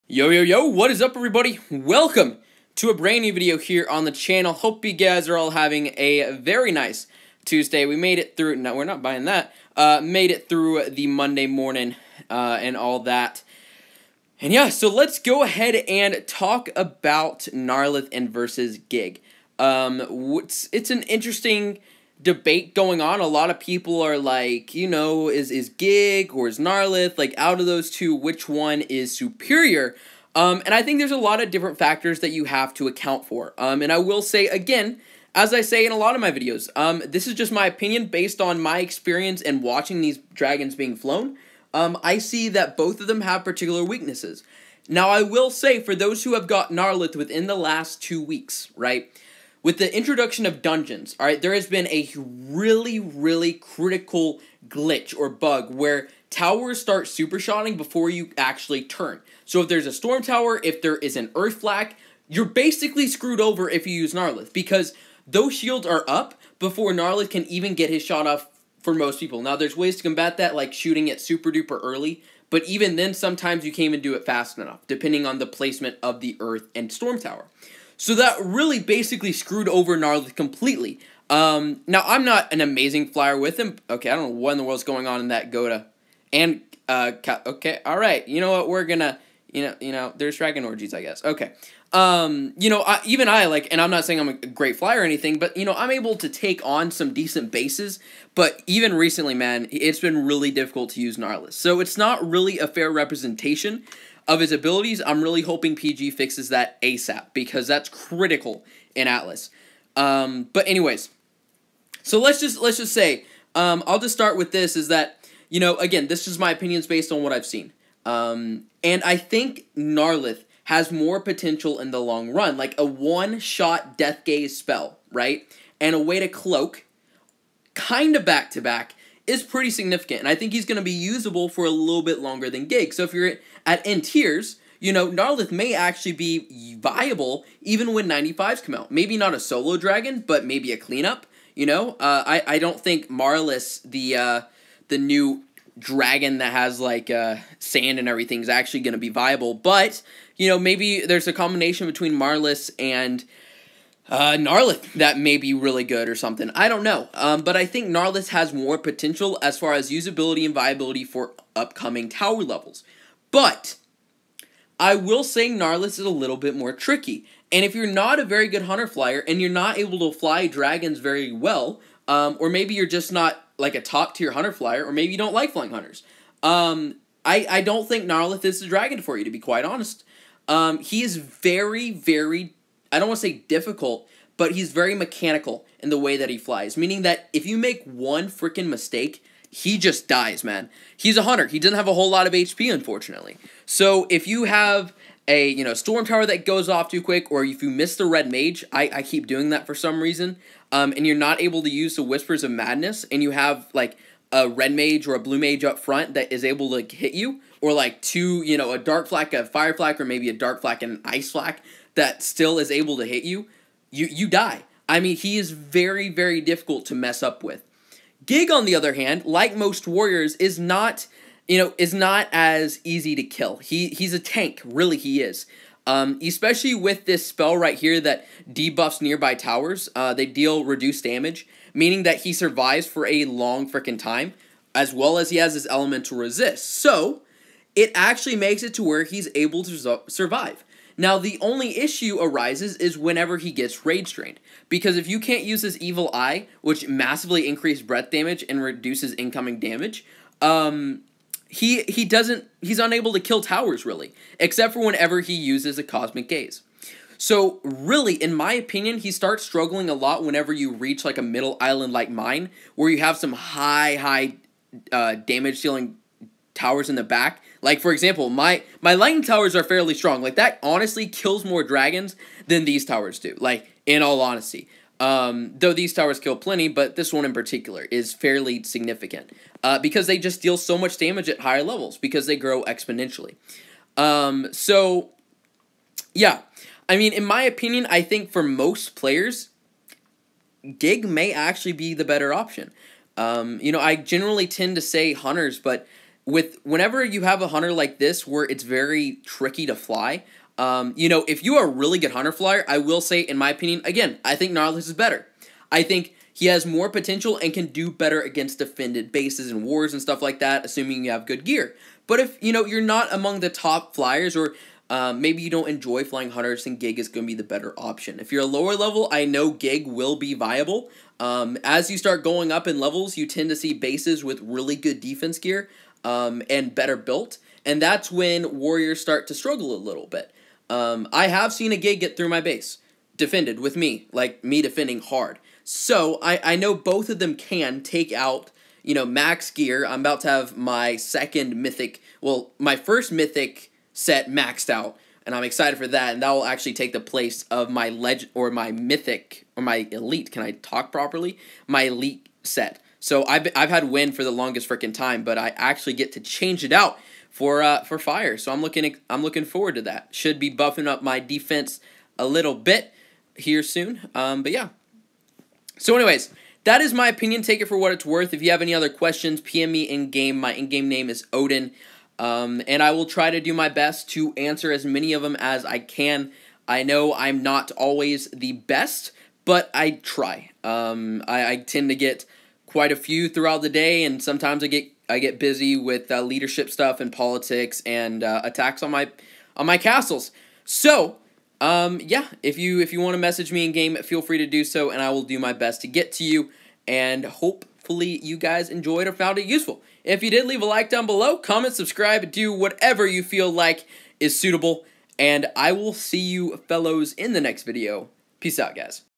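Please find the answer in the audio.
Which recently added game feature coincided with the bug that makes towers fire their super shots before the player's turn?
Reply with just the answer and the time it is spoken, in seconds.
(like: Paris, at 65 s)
Dungeons, at 50 s.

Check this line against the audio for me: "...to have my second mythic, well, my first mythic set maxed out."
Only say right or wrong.
right.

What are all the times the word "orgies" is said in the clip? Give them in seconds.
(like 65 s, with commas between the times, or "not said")
90 s.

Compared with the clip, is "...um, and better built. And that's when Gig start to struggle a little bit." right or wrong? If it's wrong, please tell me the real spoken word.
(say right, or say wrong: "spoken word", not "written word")
wrong: "Warriors", not "Gig".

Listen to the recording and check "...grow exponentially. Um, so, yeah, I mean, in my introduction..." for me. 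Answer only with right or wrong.
wrong.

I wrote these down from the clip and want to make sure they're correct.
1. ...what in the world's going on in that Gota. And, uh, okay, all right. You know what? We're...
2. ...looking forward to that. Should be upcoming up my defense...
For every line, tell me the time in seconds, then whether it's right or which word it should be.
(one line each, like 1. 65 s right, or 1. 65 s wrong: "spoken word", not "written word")
1. 84 s right
2. 359 s wrong: "buffing", not "upcoming".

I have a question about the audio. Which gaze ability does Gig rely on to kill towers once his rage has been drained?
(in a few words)
Cosmic gaze.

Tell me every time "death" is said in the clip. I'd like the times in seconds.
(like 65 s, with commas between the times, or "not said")
123 s.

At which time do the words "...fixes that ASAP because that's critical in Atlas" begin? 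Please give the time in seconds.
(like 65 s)
106 s.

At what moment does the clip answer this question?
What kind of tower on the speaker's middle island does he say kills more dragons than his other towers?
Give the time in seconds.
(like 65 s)
268 s.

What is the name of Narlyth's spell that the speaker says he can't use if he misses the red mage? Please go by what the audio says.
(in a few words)
Whispers of madness.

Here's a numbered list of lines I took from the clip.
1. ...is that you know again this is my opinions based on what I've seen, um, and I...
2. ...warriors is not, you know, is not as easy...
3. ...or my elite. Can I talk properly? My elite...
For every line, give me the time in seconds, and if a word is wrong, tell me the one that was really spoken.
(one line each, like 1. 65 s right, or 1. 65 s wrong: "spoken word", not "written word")
1. 114 s right
2. 219 s right
3. 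349 s right.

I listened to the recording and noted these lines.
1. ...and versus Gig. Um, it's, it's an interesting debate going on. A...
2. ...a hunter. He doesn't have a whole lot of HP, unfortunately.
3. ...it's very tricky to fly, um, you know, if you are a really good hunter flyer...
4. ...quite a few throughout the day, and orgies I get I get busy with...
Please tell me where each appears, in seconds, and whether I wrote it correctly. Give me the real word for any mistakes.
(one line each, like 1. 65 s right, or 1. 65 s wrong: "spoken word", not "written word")
1. 18 s right
2. 191 s right
3. 298 s right
4. 382 s wrong: "sometimes", not "orgies".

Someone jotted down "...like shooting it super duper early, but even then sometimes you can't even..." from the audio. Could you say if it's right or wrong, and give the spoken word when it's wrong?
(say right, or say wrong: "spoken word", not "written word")
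right.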